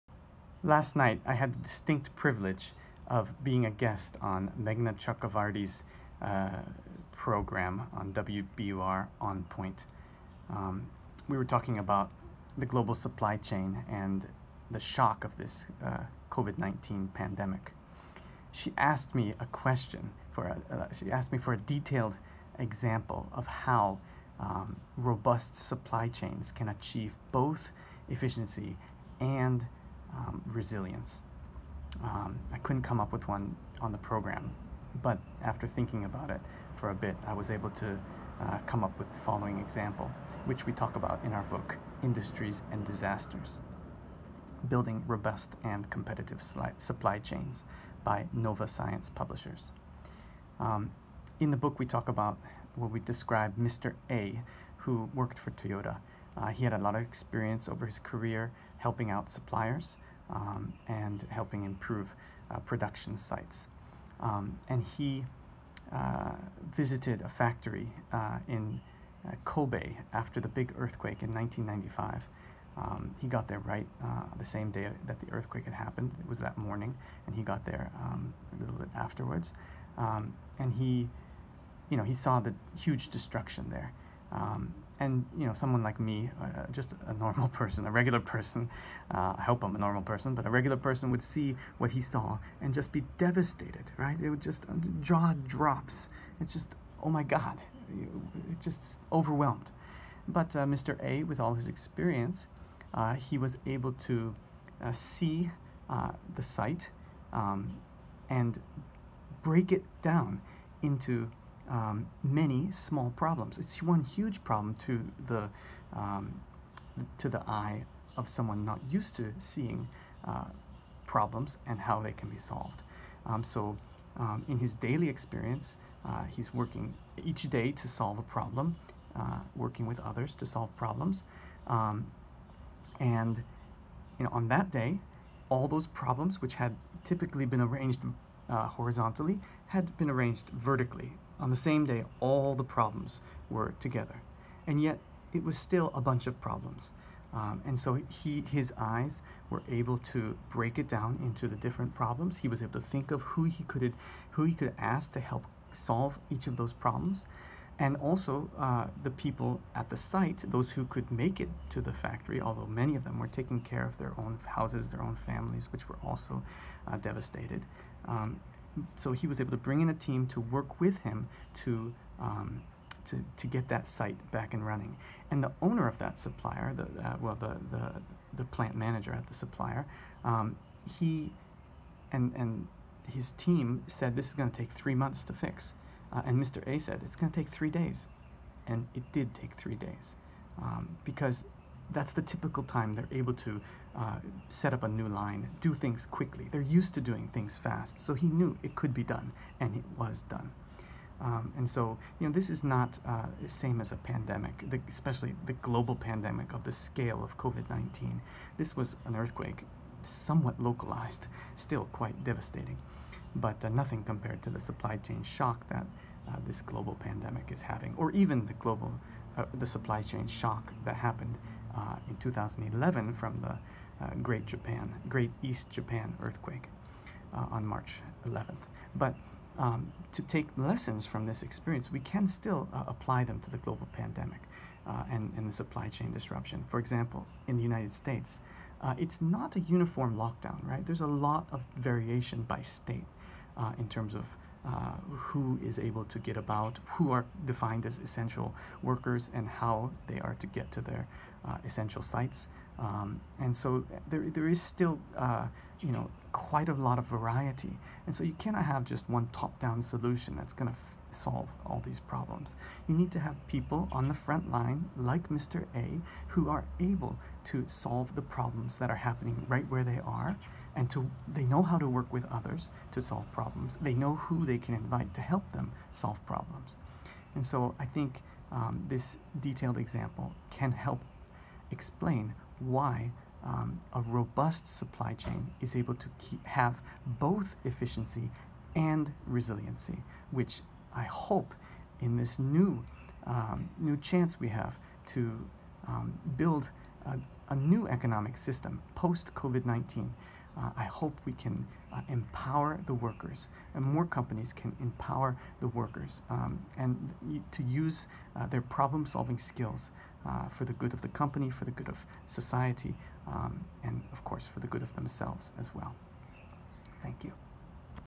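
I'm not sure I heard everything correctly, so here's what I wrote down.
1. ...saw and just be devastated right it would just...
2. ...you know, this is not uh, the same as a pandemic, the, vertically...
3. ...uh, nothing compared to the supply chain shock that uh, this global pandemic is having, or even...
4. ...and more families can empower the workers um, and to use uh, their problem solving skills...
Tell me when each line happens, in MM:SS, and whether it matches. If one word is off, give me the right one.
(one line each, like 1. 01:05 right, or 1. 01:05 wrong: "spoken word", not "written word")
1. 01:31 right
2. 03:22 wrong: "especially", not "vertically"
3. 03:33 right
4. 05:03 wrong: "companies", not "families".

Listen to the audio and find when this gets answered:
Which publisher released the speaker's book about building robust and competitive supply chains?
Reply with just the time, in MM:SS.
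00:48.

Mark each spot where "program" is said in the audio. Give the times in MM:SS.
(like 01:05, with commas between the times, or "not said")
00:07, 00:33.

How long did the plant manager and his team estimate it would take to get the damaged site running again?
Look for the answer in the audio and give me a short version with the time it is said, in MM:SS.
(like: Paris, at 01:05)
3 months, at 03:04.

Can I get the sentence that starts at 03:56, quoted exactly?
For example, in the United States, uh, it's not a uniform lockdown, right?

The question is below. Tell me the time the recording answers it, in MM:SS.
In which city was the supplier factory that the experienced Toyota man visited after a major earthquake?
01:09.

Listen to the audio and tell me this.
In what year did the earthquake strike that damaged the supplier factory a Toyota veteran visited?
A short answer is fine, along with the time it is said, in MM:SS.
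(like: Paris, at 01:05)
1995, at 01:11.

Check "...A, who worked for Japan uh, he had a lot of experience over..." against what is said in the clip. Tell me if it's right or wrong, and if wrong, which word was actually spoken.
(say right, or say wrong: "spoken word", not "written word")
wrong: "Toyota", not "Japan".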